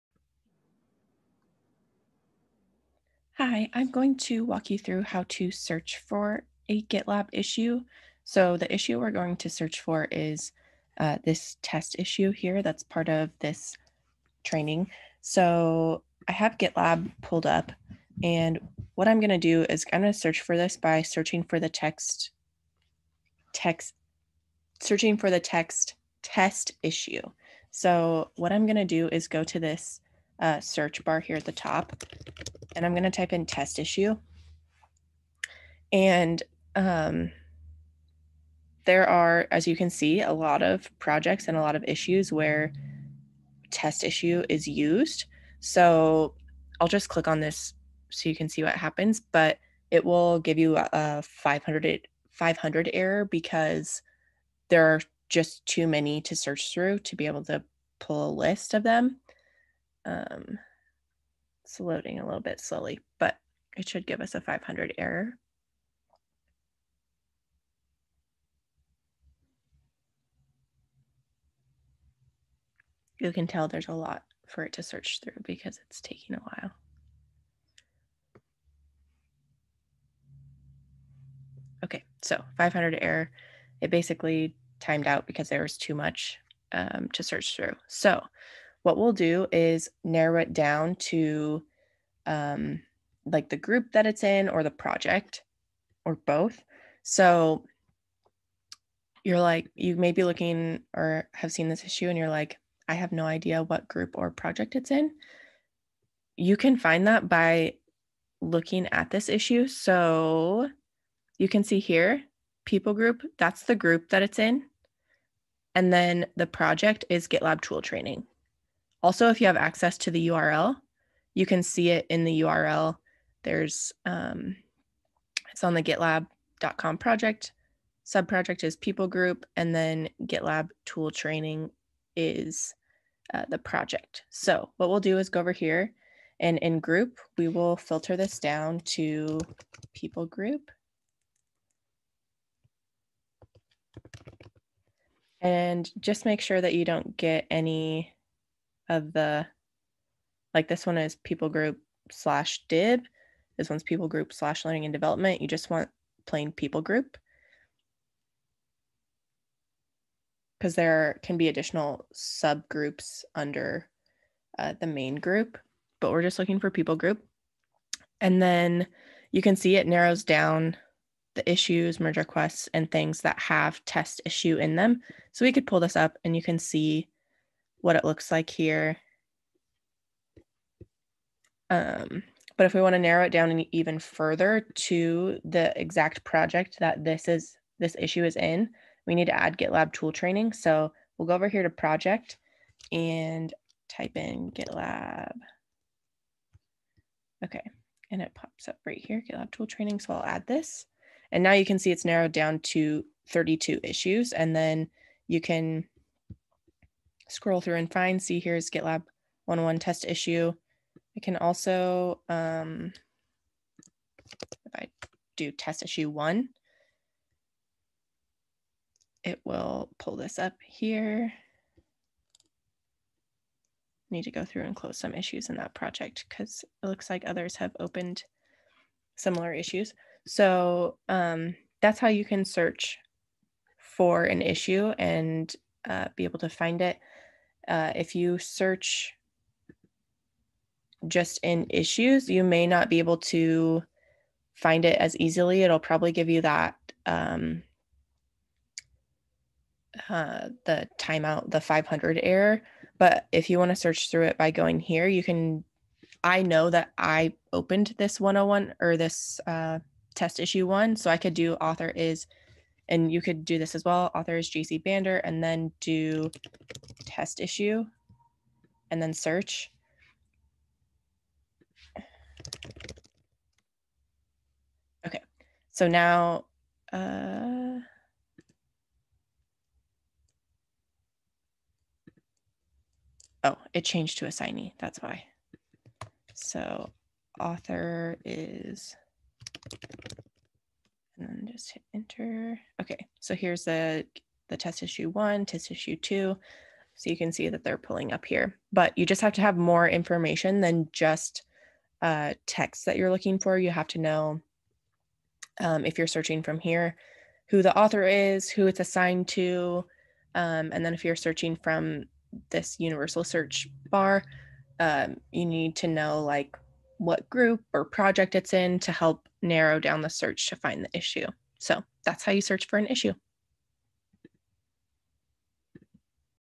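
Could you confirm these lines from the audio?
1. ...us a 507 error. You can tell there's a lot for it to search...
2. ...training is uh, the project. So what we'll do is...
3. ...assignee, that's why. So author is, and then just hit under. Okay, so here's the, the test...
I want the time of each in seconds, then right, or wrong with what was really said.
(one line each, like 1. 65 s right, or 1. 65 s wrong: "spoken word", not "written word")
1. 64 s wrong: "500", not "507"
2. 131 s right
3. 284 s wrong: "enter", not "under".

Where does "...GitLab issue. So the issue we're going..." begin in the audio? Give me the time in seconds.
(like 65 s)
6 s.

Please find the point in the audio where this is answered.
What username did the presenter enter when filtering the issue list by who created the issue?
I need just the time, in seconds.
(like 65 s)
264 s.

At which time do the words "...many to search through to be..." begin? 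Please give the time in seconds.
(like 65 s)
55 s.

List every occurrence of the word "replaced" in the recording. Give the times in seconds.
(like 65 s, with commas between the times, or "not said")
not said.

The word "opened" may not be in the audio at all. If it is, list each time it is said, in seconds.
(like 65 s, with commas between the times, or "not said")
227 s, 257 s.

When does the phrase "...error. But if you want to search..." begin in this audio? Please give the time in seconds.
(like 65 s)
252 s.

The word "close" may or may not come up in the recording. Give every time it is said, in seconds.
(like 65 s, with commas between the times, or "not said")
224 s.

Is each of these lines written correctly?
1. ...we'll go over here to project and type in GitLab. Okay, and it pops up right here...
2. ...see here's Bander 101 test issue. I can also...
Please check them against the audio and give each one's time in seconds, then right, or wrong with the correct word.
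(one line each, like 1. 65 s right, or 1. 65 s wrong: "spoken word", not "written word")
1. 191 s right
2. 208 s wrong: "GitLab", not "Bander".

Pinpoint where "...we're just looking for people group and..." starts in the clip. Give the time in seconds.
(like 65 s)
166 s.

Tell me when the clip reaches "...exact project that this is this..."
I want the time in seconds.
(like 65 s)
185 s.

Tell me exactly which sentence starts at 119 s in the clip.
Also, if you have access to the URL, you can see it in the URL.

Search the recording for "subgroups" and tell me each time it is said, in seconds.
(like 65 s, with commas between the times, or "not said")
162 s.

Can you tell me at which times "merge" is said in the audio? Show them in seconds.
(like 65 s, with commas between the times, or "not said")
172 s.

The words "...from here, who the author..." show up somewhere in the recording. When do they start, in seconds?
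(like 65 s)
306 s.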